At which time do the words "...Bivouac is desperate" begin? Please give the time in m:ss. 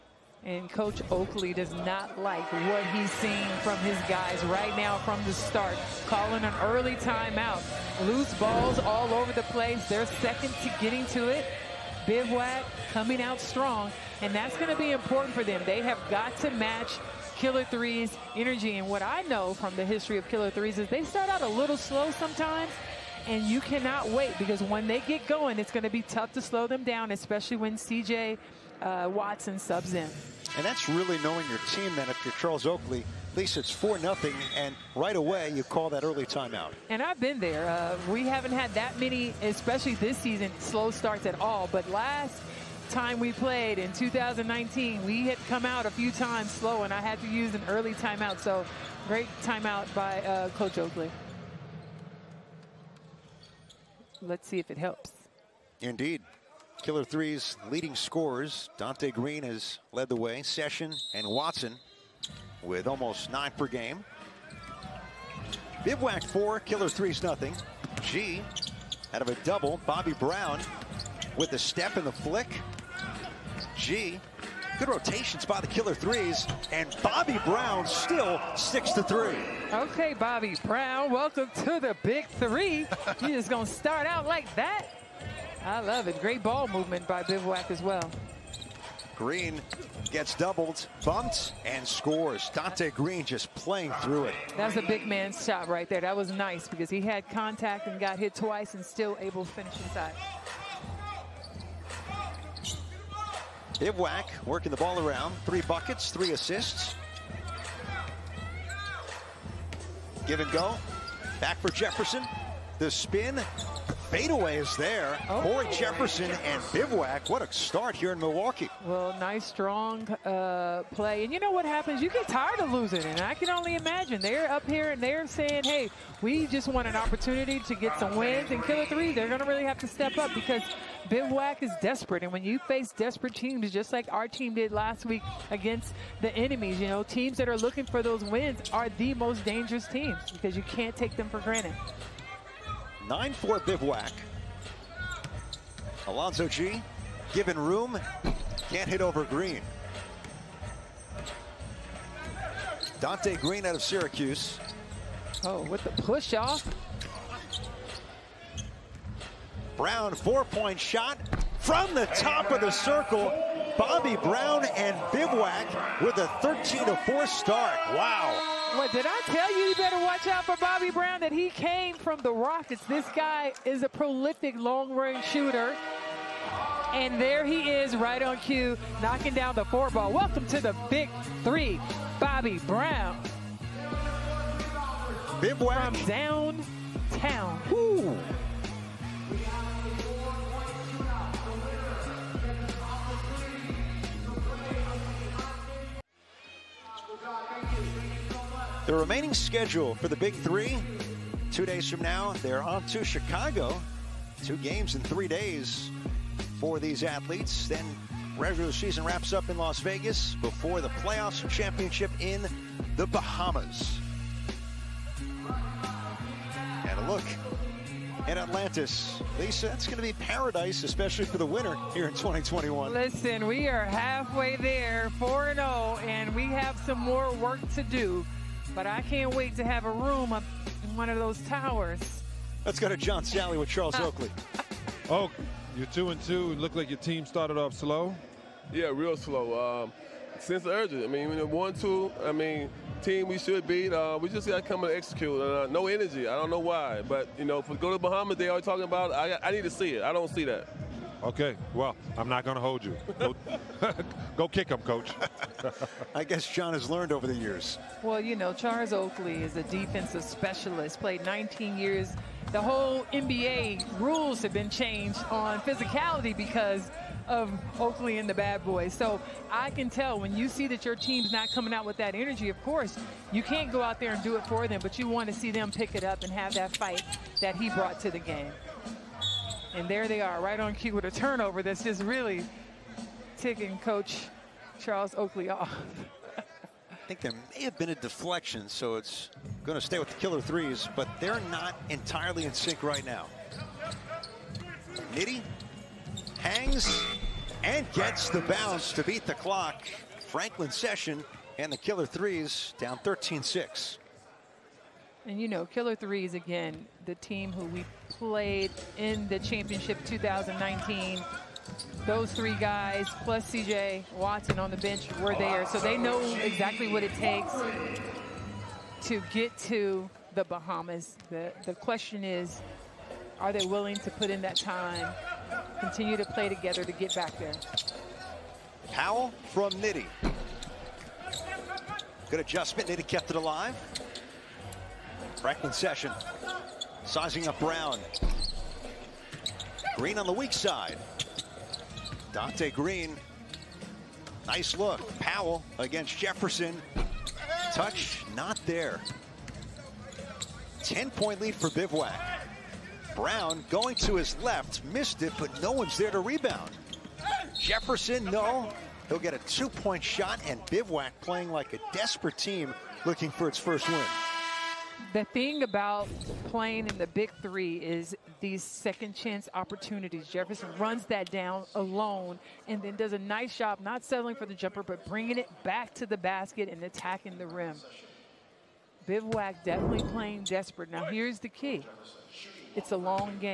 2:11.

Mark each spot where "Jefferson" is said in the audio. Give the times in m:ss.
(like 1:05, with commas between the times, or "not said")
1:51, 1:55, 5:46, 5:57, 6:10.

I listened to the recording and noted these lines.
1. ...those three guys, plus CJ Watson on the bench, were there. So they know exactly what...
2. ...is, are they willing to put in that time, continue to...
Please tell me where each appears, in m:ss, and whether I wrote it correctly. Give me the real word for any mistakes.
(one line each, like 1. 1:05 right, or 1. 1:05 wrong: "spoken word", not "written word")
1. 5:12 right
2. 5:22 right.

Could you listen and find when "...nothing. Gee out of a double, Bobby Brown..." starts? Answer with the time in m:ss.
1:07.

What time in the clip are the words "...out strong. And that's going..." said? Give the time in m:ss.
0:13.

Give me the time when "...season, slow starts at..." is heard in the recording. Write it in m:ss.
0:40.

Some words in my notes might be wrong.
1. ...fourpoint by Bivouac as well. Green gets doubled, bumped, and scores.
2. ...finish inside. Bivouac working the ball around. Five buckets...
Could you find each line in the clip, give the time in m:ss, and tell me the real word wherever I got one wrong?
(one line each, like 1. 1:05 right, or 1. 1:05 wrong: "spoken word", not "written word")
1. 1:26 wrong: "movement", not "fourpoint"
2. 1:39 wrong: "Three", not "Five".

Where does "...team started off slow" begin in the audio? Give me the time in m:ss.
3:56.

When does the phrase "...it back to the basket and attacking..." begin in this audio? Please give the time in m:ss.
6:15.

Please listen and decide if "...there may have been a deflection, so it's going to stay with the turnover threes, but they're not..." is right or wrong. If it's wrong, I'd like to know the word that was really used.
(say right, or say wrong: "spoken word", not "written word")
wrong: "killer", not "turnover".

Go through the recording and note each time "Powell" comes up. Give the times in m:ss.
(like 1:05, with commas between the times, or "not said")
5:28, 5:45.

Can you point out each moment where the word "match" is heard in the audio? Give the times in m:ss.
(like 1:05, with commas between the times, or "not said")
0:16.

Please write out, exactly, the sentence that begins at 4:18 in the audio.
Well, you know, Charles Oakley is a defensive specialist, played 19 years.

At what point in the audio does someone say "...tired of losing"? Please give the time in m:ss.
2:02.